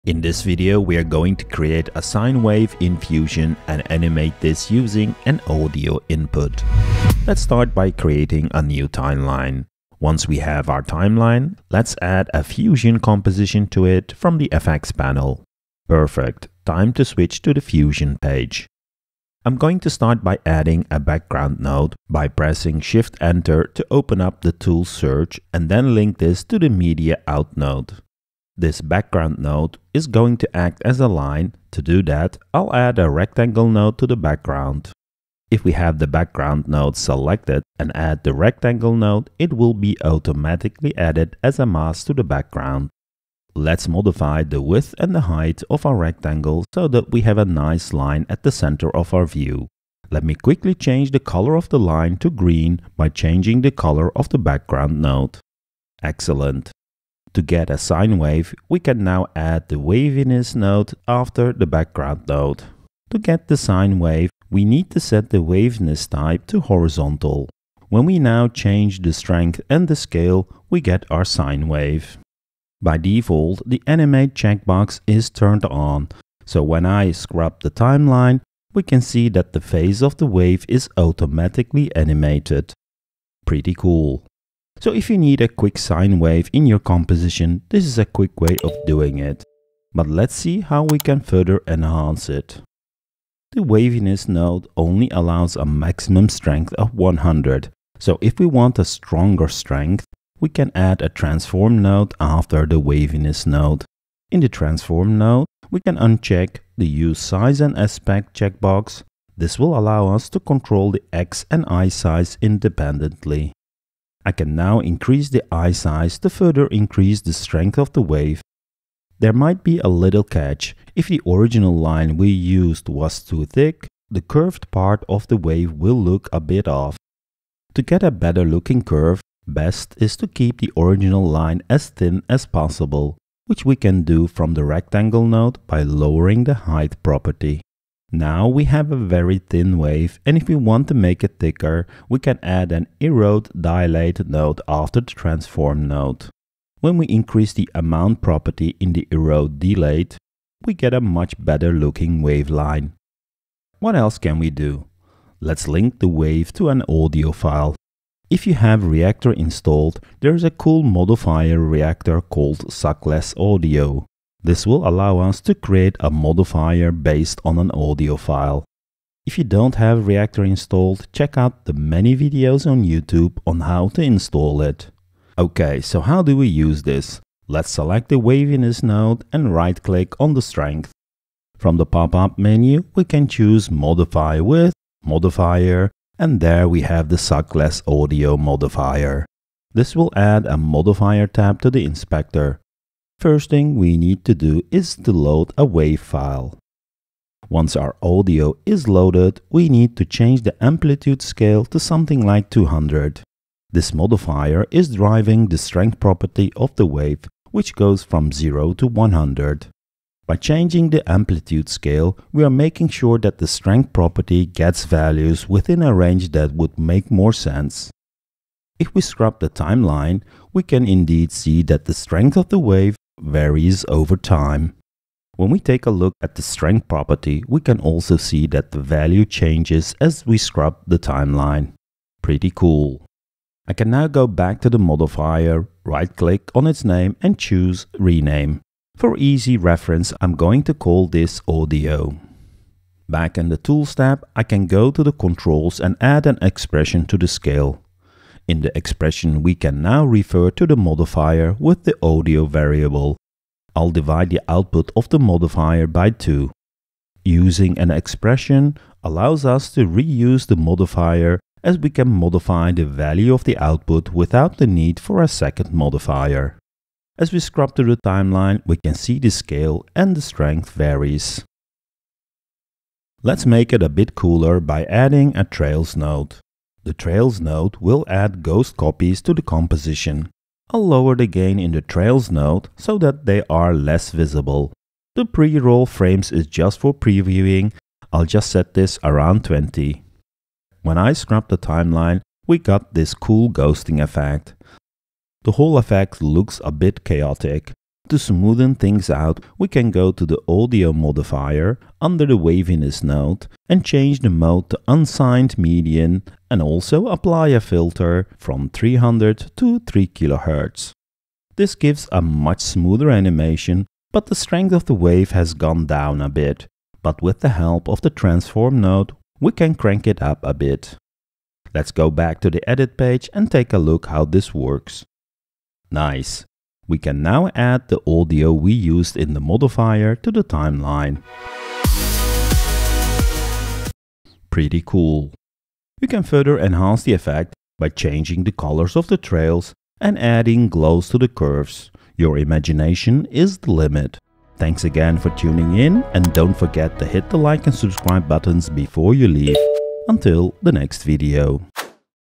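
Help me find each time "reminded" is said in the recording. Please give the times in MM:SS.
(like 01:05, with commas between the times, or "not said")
not said.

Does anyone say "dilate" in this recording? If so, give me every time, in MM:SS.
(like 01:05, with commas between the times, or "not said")
02:23, 02:29.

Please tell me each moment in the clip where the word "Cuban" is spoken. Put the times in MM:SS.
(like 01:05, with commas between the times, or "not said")
not said.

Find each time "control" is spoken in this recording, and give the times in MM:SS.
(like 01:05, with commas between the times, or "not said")
01:50, 04:05.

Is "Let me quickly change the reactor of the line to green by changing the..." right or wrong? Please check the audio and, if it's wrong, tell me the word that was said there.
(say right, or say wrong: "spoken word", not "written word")
wrong: "color", not "reactor".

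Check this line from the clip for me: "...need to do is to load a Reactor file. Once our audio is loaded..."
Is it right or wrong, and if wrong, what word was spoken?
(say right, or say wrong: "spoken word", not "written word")
wrong: "WAV", not "Reactor".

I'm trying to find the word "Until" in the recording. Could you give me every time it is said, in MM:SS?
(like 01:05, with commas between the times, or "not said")
05:50.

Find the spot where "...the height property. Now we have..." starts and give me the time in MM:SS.
02:16.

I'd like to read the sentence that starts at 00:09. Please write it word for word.
Once we have our timeline, let's add a Fusion composition to it from the FX panel.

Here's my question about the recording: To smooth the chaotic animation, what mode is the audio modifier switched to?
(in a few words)
unsigned median.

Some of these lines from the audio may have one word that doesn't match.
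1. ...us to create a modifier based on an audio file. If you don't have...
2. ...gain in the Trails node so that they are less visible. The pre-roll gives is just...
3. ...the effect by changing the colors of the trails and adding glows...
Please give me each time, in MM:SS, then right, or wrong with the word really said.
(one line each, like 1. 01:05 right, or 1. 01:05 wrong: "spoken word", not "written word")
1. 02:45 right
2. 04:41 wrong: "frames", not "gives"
3. 05:37 right.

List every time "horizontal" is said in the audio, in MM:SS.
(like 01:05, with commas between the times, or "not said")
01:06.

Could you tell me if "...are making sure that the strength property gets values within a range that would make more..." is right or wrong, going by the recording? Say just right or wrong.
right.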